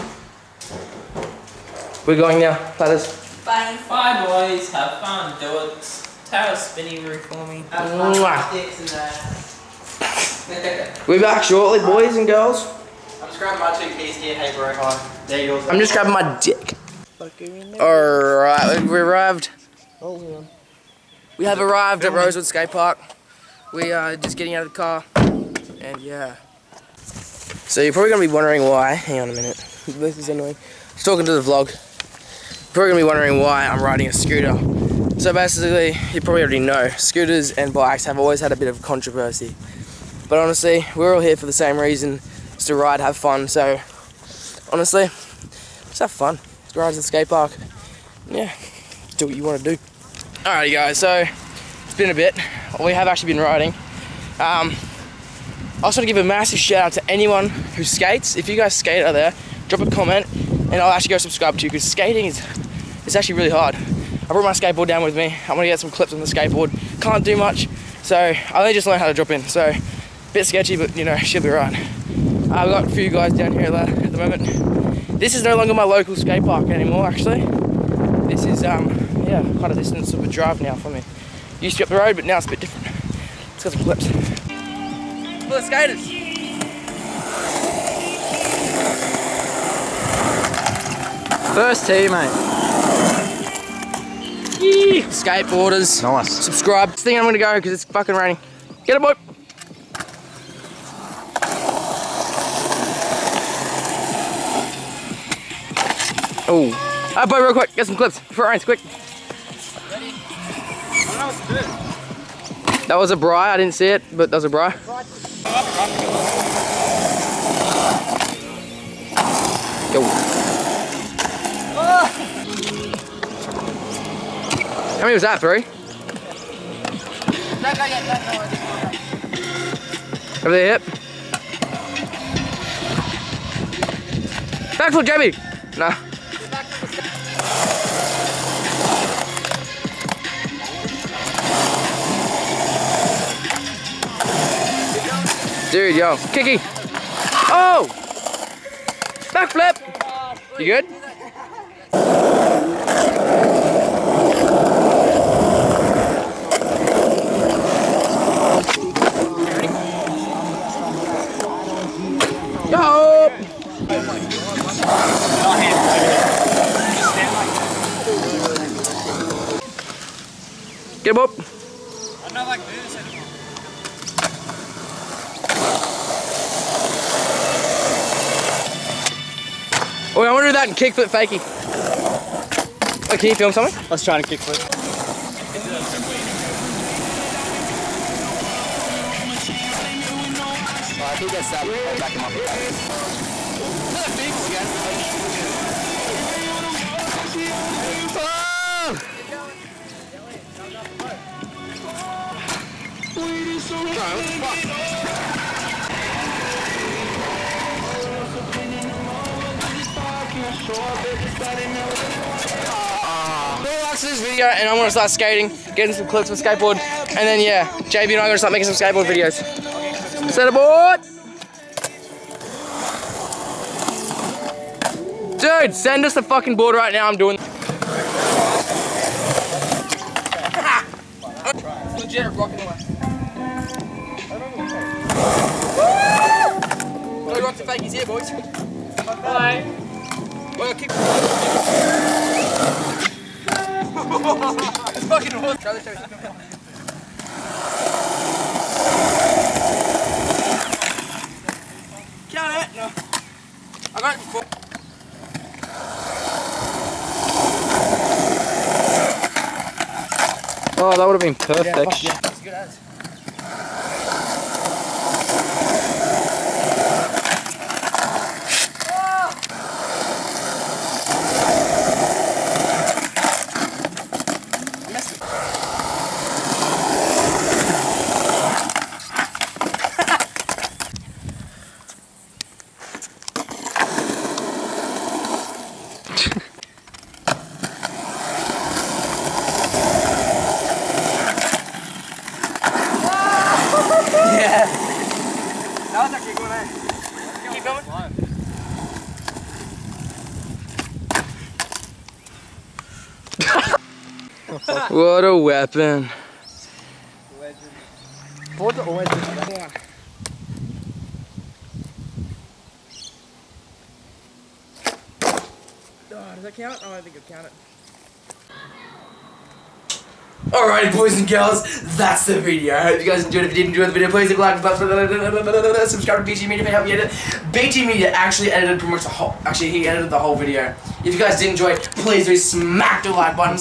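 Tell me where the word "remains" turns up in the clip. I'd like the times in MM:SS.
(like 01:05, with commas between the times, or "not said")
not said.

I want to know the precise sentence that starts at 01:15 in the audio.
This is no longer my local skate park anymore, actually.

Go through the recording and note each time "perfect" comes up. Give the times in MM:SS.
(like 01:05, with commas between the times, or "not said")
04:21.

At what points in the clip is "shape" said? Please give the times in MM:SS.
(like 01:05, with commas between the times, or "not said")
not said.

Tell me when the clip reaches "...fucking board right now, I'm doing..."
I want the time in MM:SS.
03:46.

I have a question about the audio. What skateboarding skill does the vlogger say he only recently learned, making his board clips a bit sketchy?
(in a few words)
drop in.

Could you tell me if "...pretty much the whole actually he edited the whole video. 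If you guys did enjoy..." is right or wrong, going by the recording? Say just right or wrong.
right.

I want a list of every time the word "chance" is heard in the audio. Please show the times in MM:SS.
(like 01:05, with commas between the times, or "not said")
not said.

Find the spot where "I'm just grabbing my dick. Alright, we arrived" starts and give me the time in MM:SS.
00:13.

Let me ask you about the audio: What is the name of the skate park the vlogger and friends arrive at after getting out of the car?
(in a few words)
Rosewood Skate Park.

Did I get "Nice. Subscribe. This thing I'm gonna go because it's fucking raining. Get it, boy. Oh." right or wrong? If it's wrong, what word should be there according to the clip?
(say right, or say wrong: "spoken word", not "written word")
right.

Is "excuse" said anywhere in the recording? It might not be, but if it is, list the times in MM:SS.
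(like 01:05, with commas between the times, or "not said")
not said.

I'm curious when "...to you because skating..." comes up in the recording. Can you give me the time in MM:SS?
01:01.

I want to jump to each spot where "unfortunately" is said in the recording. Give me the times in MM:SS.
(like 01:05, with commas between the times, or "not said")
not said.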